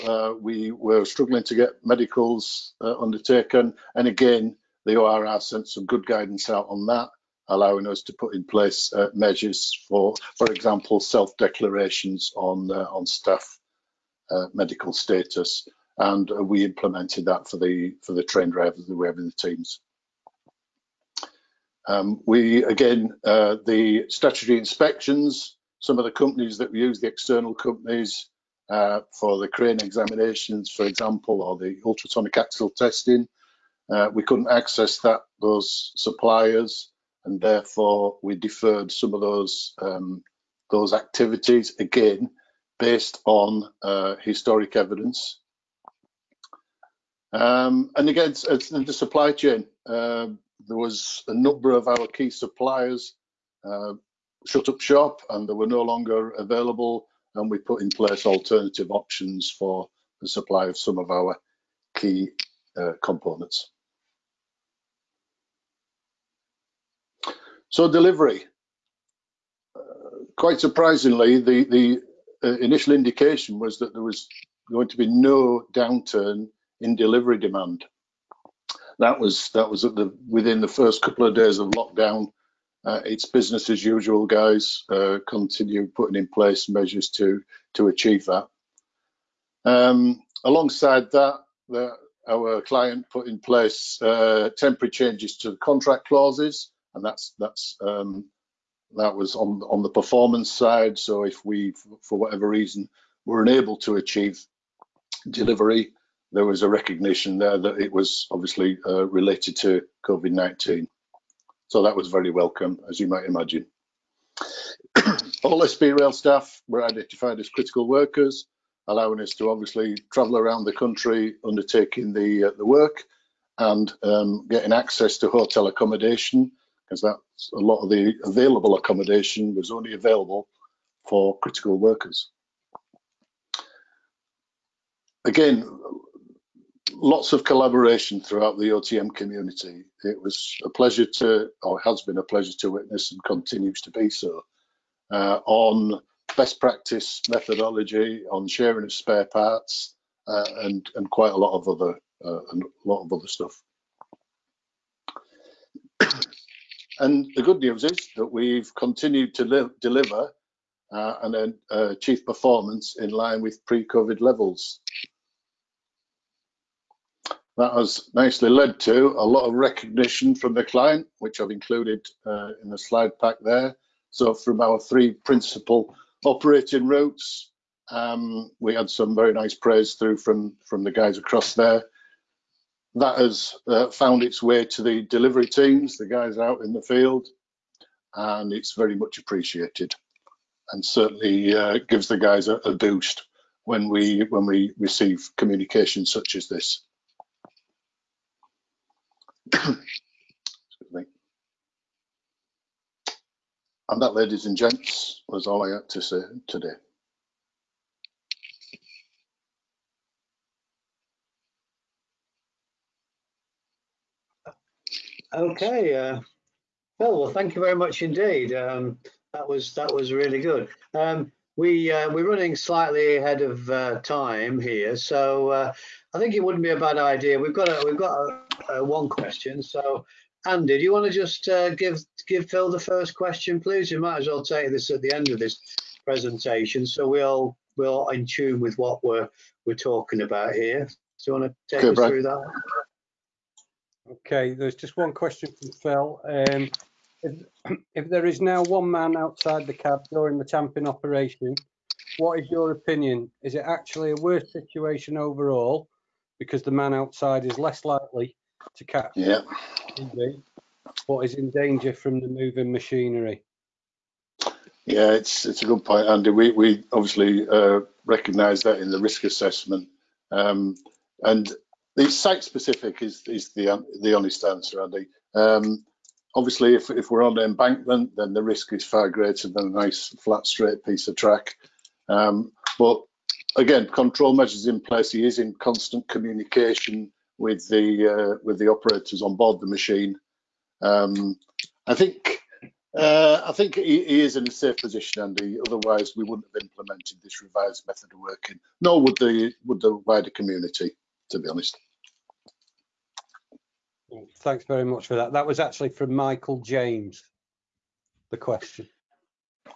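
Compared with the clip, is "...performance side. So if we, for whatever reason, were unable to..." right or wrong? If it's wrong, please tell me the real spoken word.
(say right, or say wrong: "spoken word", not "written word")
right.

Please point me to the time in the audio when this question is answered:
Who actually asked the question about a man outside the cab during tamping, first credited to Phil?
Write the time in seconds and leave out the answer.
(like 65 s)
306 s.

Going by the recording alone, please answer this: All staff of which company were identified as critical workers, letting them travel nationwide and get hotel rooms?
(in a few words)
SB Rail.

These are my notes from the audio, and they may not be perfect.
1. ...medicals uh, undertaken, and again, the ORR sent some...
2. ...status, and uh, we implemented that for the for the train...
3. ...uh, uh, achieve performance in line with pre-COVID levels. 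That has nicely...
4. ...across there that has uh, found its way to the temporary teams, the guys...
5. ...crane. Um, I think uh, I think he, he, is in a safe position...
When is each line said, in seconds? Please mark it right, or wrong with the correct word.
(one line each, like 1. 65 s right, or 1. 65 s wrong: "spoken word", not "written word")
1. 1 s right
2. 14 s right
3. 161 s right
4. 181 s wrong: "delivery", not "temporary"
5. 289 s wrong: "machine", not "crane".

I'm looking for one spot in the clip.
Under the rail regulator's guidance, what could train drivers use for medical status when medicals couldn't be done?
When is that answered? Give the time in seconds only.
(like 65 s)
10 s.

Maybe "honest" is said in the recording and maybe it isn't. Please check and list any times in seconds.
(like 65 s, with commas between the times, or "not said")
274 s, 301 s.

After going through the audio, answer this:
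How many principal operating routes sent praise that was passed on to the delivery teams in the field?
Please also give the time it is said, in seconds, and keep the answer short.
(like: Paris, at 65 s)
3, at 174 s.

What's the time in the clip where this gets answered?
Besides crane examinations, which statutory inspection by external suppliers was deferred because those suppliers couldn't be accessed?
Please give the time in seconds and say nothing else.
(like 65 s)
31 s.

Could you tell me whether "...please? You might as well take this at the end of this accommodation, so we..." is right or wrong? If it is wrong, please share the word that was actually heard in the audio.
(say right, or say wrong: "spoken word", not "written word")
wrong: "presentation", not "accommodation".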